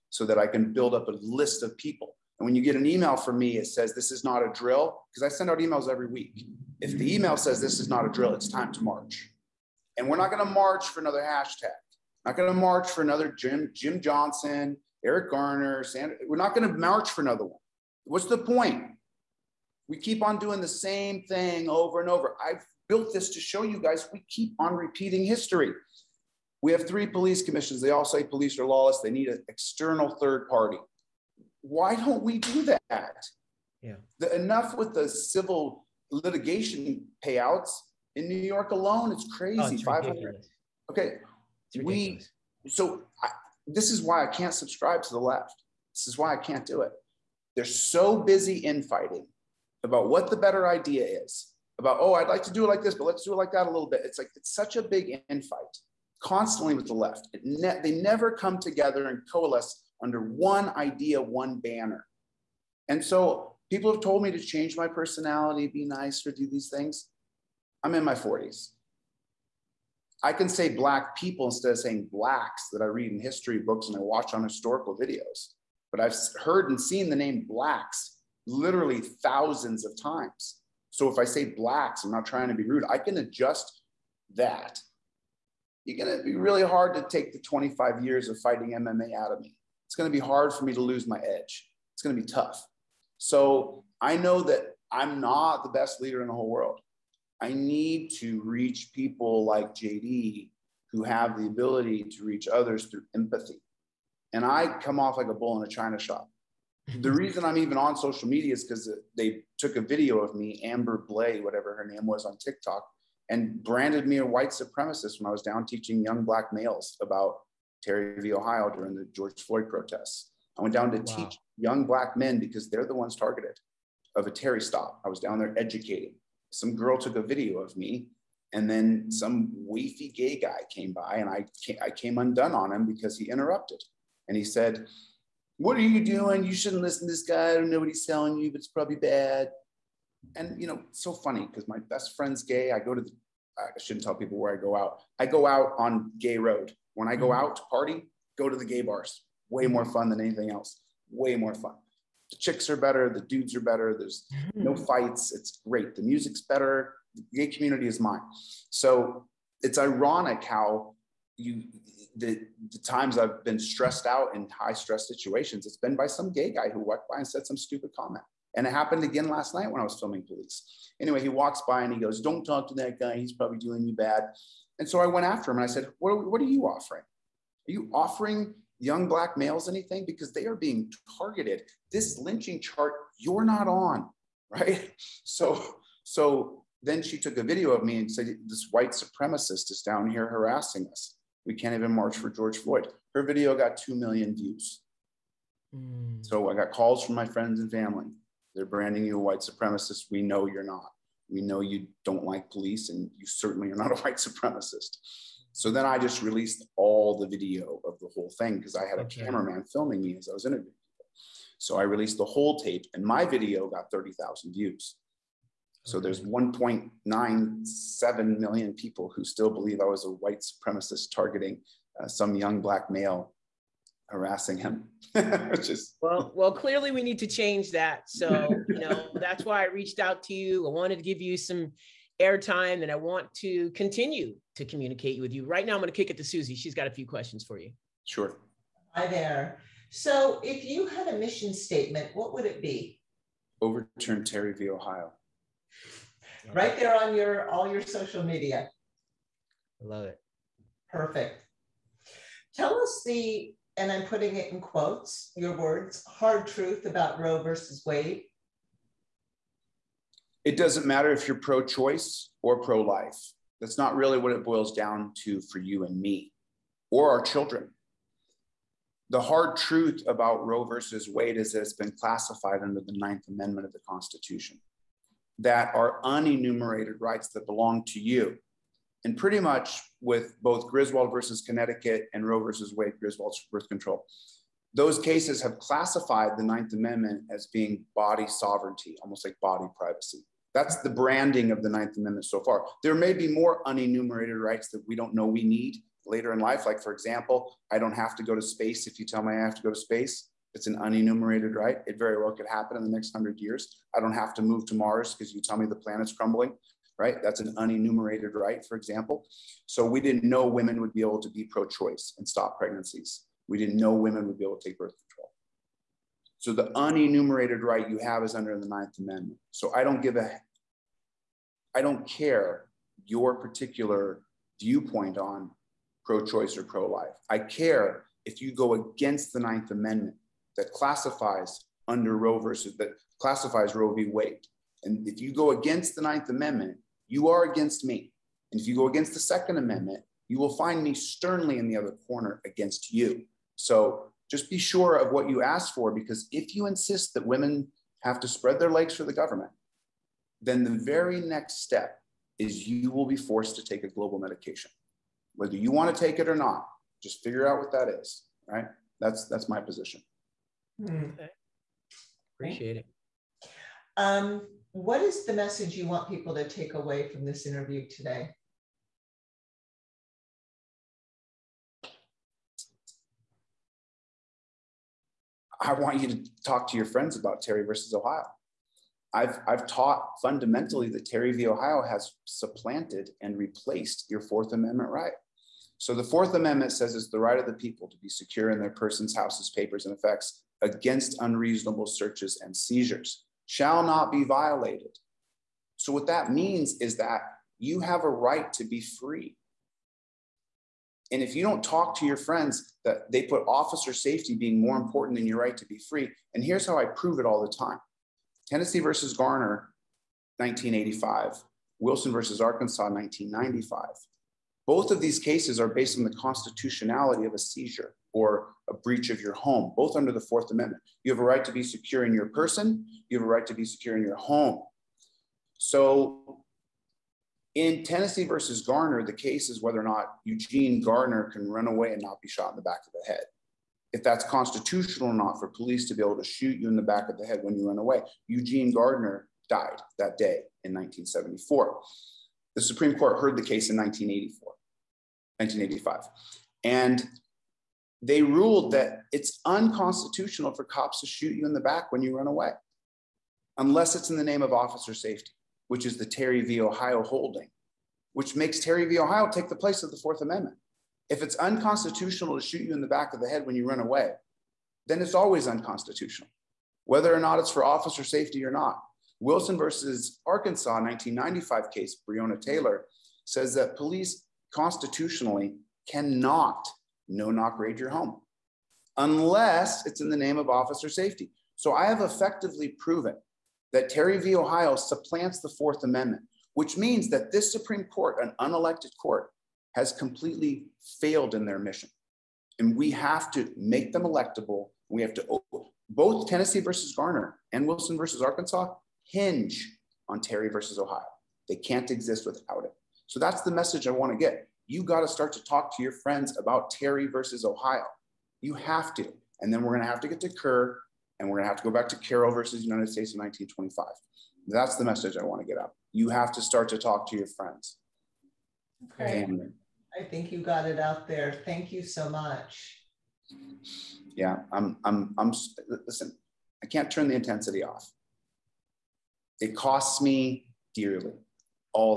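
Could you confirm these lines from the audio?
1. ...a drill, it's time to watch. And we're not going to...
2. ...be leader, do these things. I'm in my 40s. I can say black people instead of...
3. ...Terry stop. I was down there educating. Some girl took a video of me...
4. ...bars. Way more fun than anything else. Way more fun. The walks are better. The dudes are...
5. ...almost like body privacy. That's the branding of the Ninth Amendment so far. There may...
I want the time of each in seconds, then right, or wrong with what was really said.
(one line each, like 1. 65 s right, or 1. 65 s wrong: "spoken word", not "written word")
1. 8 s wrong: "march", not "watch"
2. 65 s wrong: "nicer", not "leader"
3. 124 s right
4. 148 s wrong: "chicks", not "walks"
5. 289 s right.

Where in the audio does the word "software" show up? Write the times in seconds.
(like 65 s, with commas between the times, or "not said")
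not said.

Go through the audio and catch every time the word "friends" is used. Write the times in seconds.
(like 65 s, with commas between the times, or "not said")
142 s, 197 s, 376 s, 402 s, 505 s, 517 s.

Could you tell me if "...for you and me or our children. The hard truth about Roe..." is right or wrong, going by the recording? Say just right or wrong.
right.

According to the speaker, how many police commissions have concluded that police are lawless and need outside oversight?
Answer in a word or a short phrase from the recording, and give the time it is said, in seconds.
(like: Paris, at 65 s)
3, at 26 s.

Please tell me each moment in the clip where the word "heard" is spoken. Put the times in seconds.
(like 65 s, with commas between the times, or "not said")
76 s, 443 s.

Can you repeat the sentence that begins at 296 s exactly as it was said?
Like, for example, I don't have to go to space if you tell me I have to go to space.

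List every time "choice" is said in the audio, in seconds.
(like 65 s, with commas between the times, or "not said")
261 s, 311 s, 326 s.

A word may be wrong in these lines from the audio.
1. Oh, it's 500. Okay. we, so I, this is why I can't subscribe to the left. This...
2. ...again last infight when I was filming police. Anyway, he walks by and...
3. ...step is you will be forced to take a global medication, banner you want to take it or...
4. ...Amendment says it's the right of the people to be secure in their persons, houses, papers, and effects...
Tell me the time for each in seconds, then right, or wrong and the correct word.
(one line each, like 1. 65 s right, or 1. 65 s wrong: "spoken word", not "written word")
1. 39 s right
2. 169 s wrong: "night", not "infight"
3. 351 s wrong: "whether", not "banner"
4. 386 s right.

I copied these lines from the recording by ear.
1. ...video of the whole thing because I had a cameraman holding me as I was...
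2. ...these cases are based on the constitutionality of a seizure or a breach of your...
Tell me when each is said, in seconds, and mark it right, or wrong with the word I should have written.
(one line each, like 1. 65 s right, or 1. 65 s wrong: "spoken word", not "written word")
1. 207 s wrong: "filming", not "holding"
2. 415 s right.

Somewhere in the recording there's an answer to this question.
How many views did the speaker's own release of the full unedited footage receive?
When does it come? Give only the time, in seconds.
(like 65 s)
213 s.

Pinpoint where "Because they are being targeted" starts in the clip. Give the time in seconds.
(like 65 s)
180 s.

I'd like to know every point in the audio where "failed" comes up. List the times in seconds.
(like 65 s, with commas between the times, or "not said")
490 s.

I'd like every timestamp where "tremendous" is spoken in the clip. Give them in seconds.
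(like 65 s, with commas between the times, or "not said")
not said.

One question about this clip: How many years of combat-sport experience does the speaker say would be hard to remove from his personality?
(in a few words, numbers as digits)
25.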